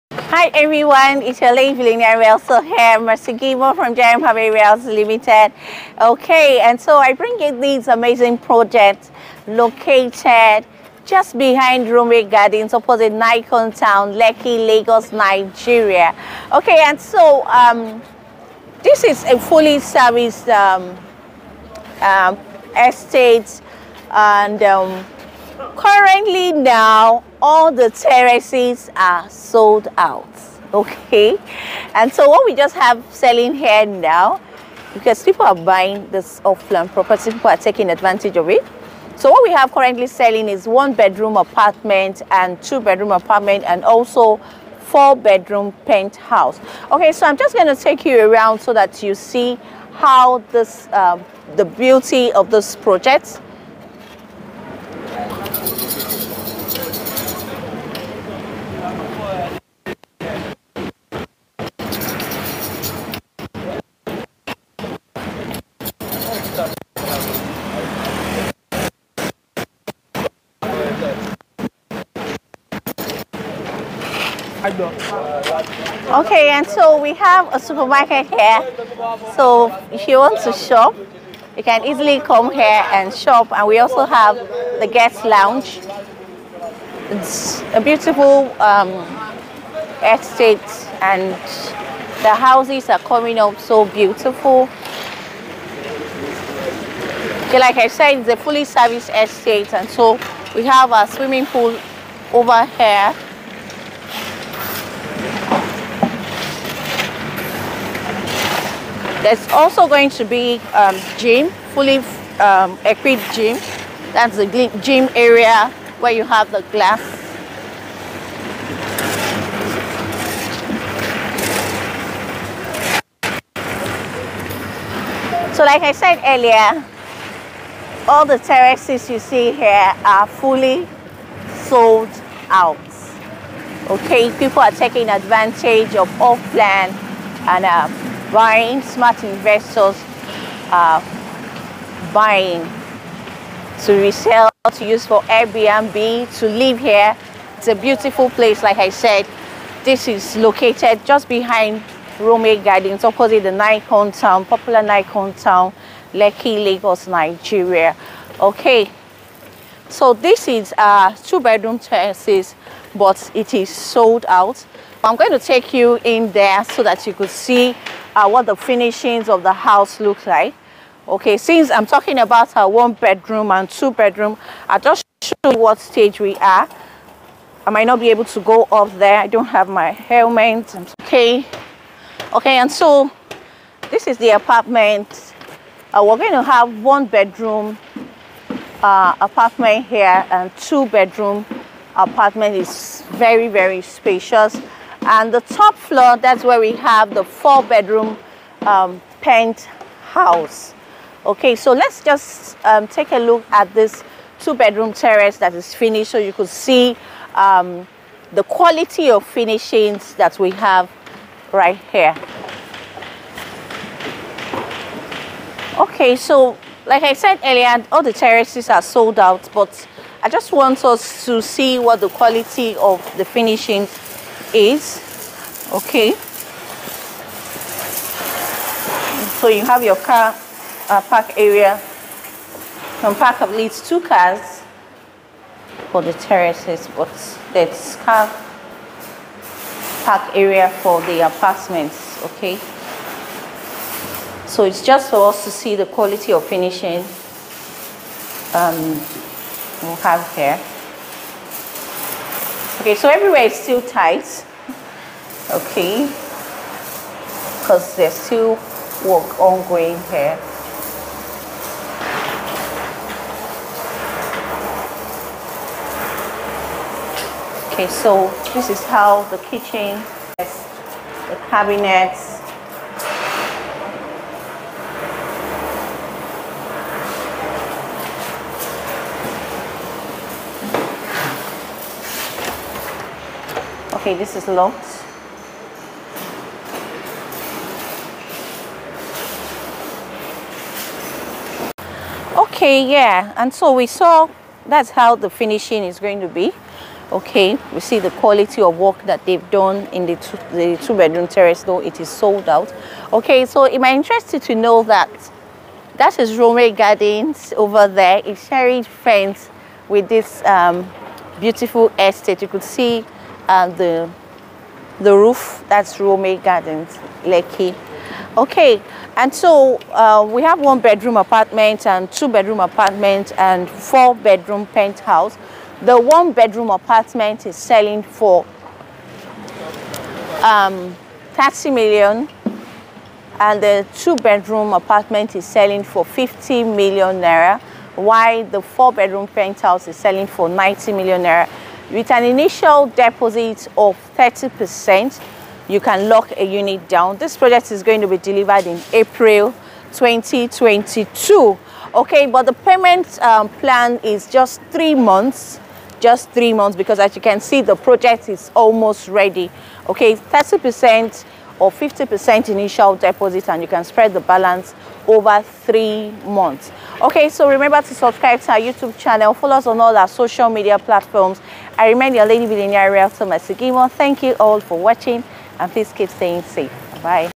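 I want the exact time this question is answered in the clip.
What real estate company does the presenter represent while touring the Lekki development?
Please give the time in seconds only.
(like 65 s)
3 s.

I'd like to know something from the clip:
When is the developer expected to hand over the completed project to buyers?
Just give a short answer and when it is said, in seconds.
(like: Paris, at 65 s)
April 2022, at 348 s.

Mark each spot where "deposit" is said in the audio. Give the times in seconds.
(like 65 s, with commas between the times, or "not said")
342 s, 362 s.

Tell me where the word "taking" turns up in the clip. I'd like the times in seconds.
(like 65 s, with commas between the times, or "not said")
37 s, 134 s.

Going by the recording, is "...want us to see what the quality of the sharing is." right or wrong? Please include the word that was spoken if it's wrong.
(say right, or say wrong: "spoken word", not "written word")
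wrong: "finishing", not "sharing".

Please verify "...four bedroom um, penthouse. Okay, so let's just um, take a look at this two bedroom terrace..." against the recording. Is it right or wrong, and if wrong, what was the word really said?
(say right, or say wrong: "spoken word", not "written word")
right.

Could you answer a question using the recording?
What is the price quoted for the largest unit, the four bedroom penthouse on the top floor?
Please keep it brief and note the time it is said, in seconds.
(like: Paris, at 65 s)
90 million naira, at 340 s.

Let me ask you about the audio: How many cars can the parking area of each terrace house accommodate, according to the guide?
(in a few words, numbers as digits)
2.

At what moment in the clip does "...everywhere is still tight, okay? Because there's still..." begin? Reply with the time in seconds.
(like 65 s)
253 s.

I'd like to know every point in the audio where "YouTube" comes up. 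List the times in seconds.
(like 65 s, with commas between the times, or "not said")
368 s.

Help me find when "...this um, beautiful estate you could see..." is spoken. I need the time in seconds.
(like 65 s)
310 s.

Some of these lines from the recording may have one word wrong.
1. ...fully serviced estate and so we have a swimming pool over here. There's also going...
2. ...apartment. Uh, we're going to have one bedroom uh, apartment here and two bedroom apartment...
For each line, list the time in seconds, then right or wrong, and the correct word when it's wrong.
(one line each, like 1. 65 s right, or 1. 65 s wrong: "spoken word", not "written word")
1. 98 s right
2. 184 s right.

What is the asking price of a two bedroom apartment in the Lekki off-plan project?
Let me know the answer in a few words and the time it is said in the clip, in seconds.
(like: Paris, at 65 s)
50 million naira, at 336 s.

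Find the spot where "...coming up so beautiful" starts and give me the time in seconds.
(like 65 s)
92 s.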